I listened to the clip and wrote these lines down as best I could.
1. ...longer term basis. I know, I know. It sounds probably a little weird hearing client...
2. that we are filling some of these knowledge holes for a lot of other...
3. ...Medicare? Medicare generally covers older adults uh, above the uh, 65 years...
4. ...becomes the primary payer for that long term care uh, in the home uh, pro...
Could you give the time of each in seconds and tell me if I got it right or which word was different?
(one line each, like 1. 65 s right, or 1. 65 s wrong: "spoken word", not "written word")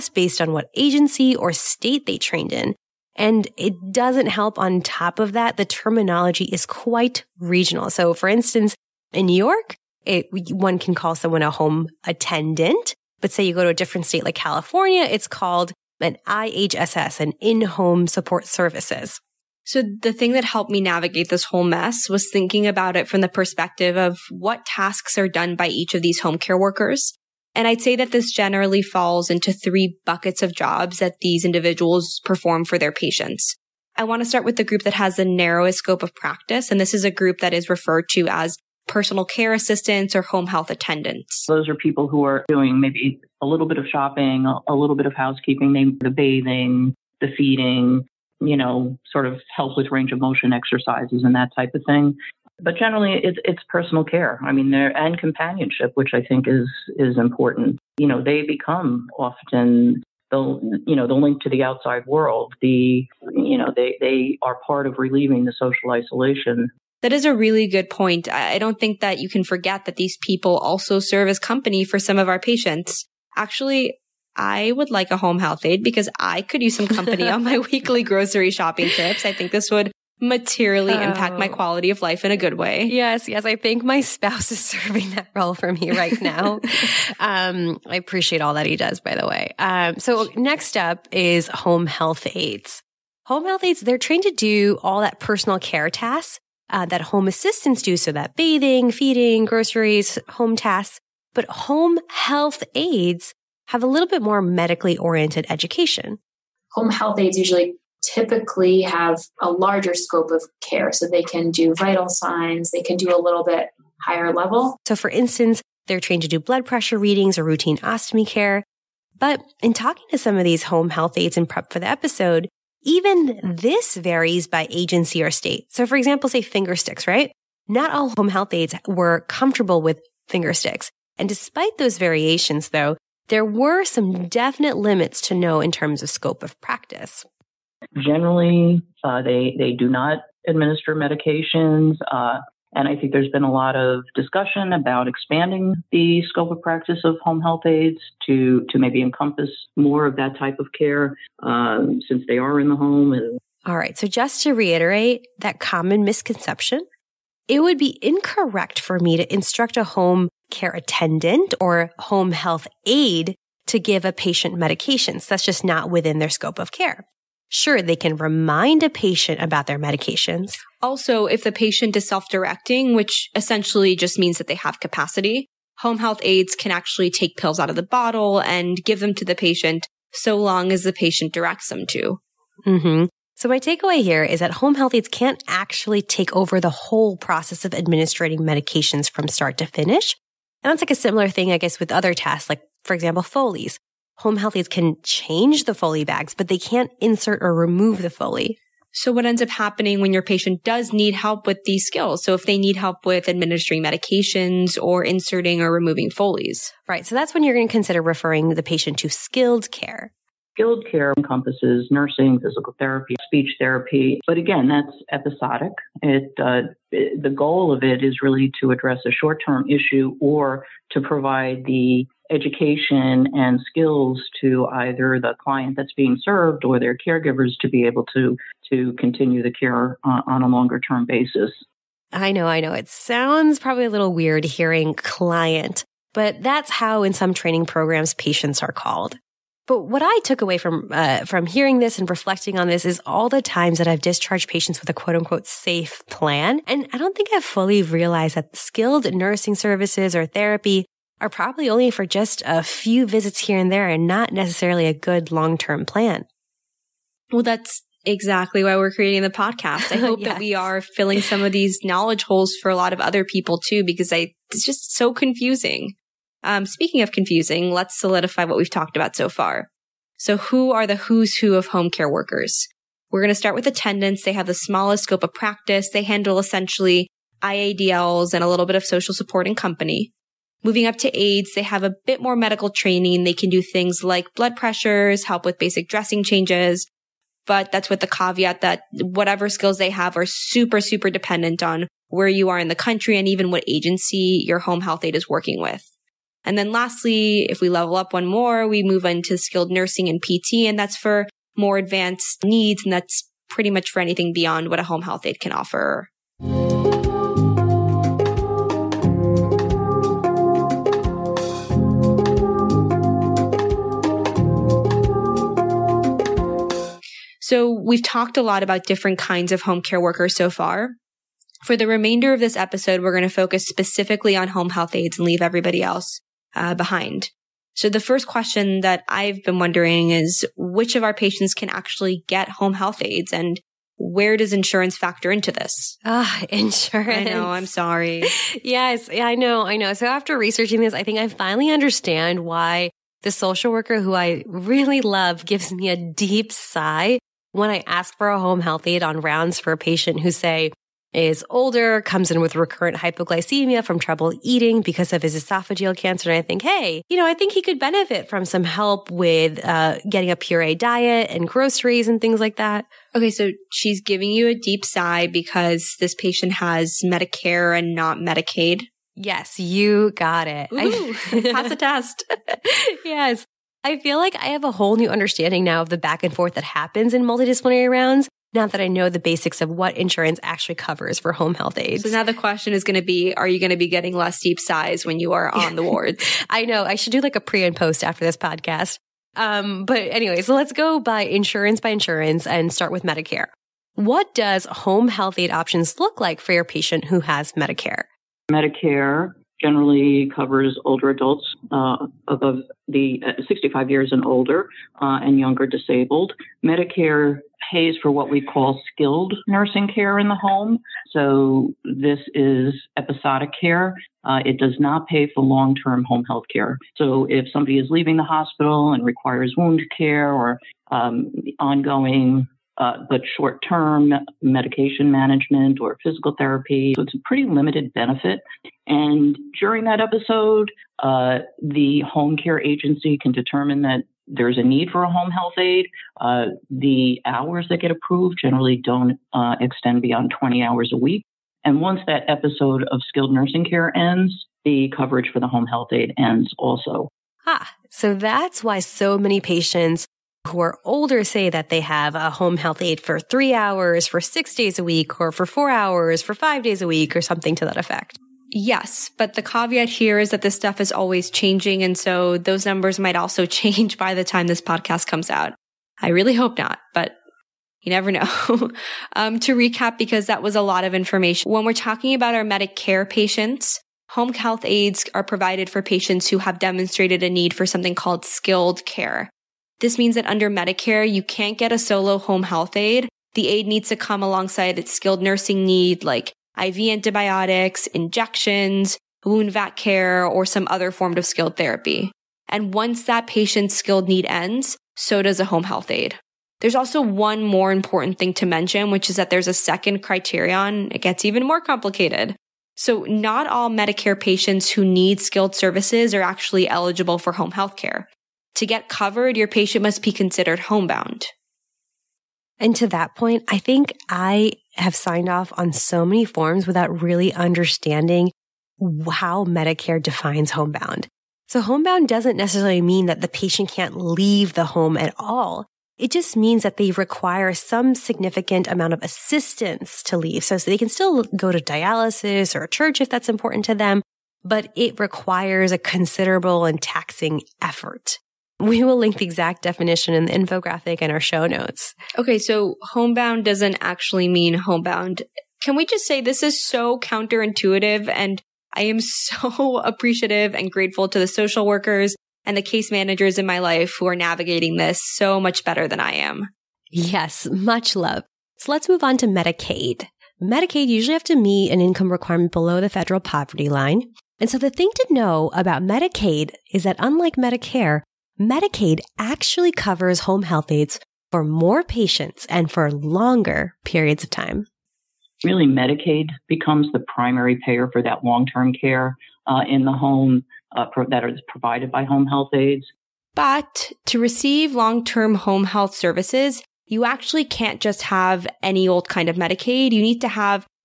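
1. 230 s right
2. 260 s right
3. 397 s right
4. 576 s right.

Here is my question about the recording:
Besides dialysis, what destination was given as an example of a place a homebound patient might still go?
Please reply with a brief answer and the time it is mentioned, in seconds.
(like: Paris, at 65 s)
Church, at 532 s.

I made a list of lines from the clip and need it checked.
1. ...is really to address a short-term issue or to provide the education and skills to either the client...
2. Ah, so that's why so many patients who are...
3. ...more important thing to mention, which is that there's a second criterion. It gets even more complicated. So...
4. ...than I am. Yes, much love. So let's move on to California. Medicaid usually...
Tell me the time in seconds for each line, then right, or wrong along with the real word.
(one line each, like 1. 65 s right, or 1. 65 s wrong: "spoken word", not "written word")
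1. 218 s right
2. 447 s right
3. 497 s right
4. 555 s wrong: "Medicaid", not "California".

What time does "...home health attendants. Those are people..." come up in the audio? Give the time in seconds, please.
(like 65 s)
40 s.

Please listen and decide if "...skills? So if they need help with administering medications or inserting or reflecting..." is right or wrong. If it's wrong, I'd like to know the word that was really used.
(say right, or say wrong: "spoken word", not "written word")
wrong: "removing", not "reflecting".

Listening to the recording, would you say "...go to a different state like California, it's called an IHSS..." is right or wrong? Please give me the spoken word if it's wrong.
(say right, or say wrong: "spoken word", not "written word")
right.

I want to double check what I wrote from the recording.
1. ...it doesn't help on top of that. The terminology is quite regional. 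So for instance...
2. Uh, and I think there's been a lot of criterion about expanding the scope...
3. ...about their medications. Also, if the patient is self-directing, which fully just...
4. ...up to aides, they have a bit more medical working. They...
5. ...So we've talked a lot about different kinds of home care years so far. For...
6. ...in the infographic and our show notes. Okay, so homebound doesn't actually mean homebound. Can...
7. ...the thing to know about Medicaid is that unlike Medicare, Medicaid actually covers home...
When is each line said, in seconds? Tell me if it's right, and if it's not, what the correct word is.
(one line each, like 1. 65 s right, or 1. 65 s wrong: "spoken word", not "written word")
1. 3 s right
2. 142 s wrong: "discussion", not "criterion"
3. 169 s wrong: "essentially", not "fully"
4. 280 s wrong: "training", not "working"
5. 317 s wrong: "workers", not "years"
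6. 540 s right
7. 564 s right.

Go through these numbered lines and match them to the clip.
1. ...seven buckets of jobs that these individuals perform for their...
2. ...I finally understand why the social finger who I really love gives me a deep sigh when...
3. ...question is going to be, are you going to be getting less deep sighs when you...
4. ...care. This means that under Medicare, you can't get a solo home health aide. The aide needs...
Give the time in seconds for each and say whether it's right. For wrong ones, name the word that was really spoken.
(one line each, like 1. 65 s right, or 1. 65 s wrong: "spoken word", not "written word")
1. 29 s wrong: "three", not "seven"
2. 341 s wrong: "worker", not "finger"
3. 382 s right
4. 478 s right.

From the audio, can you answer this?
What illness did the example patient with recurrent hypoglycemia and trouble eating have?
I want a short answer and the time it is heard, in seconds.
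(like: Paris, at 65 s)
Esophageal cancer, at 355 s.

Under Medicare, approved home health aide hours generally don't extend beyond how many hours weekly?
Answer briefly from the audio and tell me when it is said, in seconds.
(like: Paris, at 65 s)
20, at 440 s.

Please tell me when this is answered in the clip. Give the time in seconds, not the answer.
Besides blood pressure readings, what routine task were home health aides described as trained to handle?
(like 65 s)
117 s.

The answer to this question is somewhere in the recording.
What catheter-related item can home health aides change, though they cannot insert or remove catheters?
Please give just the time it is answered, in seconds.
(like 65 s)
195 s.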